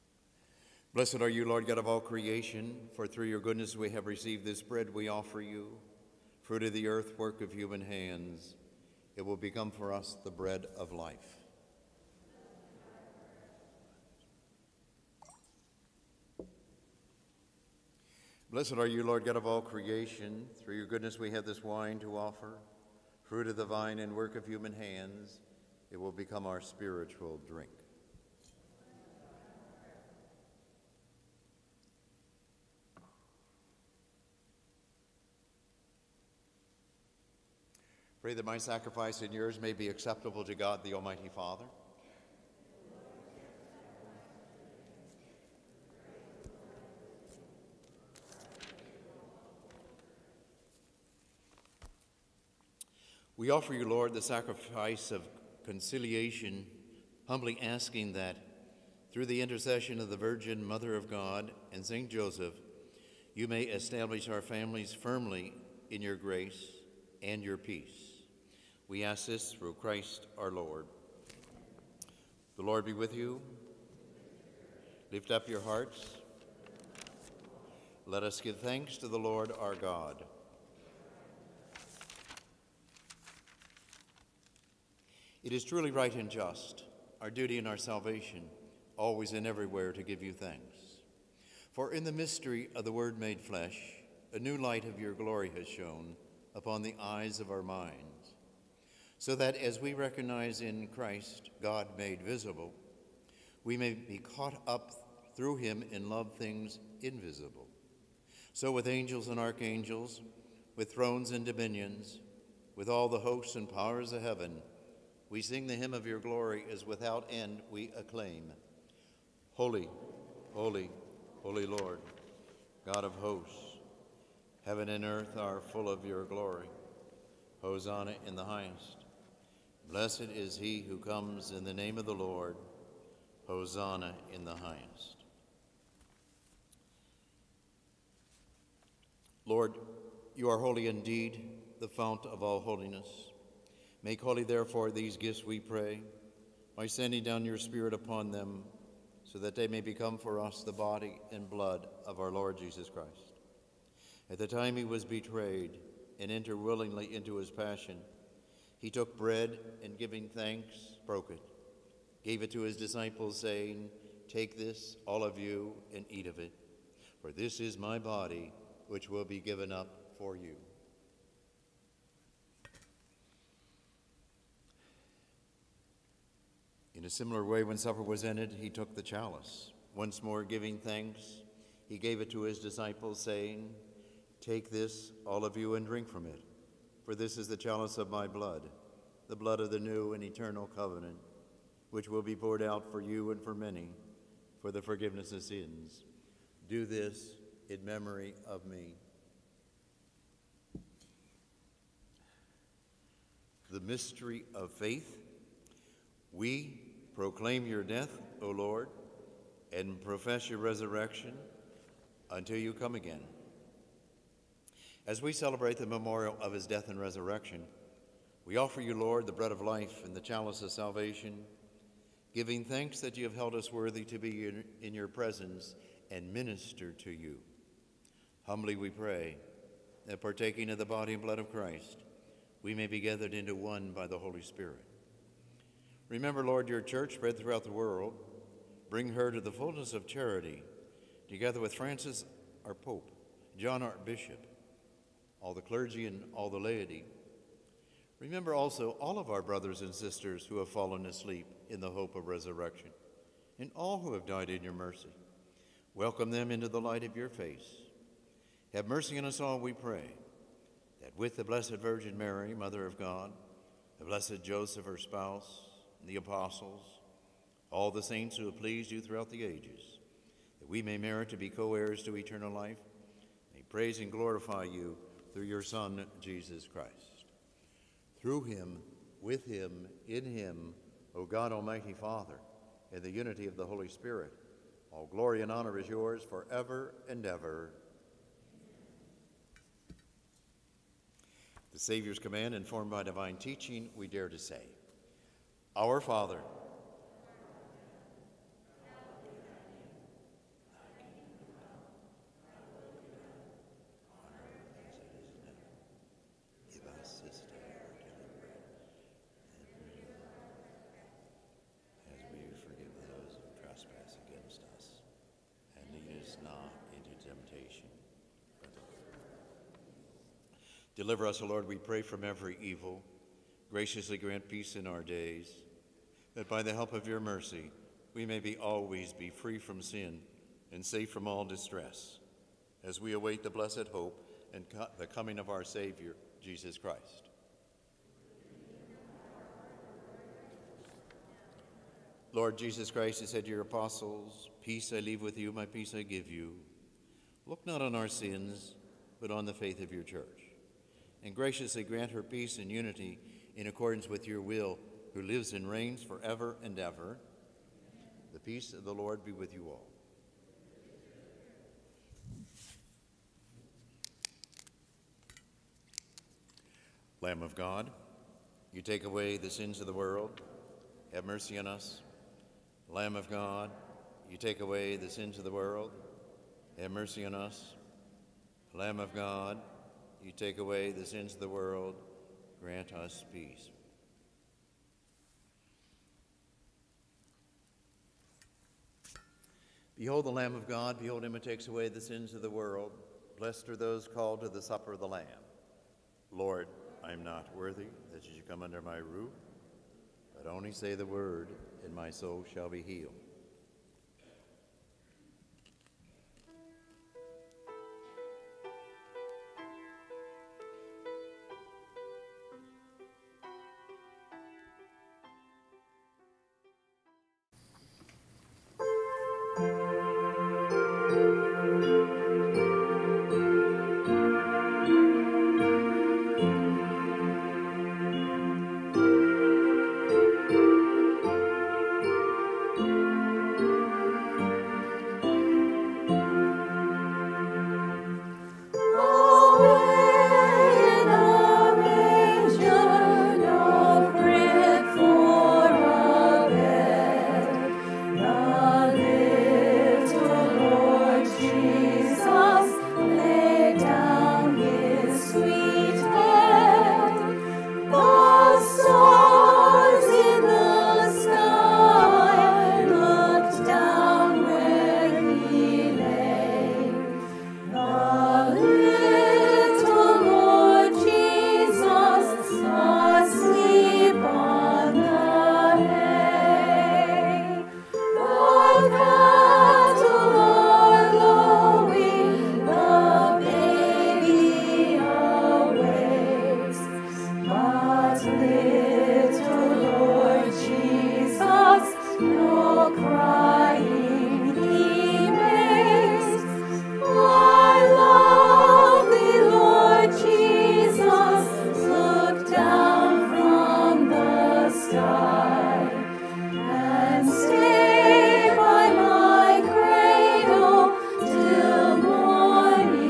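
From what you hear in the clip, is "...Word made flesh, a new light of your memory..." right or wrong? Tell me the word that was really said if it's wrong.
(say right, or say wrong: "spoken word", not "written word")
wrong: "glory", not "memory".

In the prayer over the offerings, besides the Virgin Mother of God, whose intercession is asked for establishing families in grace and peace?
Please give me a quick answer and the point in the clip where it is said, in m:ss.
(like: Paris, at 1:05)
St. Joseph, at 1:01.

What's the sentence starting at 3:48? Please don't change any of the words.
Humbly we pray that partaking of the body and blood of Christ, we may be gathered into one by the Holy Spirit.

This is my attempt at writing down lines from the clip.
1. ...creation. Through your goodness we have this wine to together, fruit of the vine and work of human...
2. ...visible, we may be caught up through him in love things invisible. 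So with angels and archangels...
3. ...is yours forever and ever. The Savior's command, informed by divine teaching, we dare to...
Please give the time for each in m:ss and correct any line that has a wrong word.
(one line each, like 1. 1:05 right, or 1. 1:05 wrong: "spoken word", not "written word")
1. 0:19 wrong: "offer", not "together"
2. 1:42 right
3. 4:45 right.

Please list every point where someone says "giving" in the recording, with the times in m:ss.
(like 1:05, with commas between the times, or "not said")
2:39, 3:00, 3:42.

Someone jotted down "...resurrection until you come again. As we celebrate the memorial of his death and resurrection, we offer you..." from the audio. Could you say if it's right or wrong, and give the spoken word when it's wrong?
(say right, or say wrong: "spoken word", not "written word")
right.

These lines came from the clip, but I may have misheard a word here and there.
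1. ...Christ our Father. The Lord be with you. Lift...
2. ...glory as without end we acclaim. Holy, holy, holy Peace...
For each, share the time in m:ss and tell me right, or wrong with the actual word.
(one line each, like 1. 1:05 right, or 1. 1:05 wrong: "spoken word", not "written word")
1. 1:09 wrong: "Lord", not "Father"
2. 1:56 wrong: "Lord", not "Peace".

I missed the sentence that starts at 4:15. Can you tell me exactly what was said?
Welcome them into the light of your face.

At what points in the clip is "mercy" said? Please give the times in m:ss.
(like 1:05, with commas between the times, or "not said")
4:14, 4:18, 5:27, 6:11, 6:16.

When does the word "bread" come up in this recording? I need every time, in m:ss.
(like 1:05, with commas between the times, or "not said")
0:04, 0:10, 2:39, 3:39.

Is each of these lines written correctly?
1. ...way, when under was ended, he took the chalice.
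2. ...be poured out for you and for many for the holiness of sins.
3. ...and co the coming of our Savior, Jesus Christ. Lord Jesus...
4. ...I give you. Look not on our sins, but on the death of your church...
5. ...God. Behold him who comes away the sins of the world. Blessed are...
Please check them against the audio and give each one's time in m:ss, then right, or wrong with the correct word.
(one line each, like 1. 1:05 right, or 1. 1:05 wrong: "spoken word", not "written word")
1. 2:57 wrong: "supper", not "under"
2. 3:12 wrong: "forgiveness", not "holiness"
3. 5:34 right
4. 5:45 wrong: "faith", not "death"
5. 6:30 wrong: "takes", not "comes".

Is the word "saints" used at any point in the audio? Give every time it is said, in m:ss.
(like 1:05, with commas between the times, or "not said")
4:28.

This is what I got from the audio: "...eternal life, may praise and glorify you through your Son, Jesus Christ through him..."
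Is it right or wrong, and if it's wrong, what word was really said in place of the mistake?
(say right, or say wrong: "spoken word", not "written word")
right.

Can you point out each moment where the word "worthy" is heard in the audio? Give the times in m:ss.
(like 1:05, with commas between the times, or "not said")
3:43, 6:37.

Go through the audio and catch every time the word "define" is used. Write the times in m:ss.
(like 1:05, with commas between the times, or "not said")
not said.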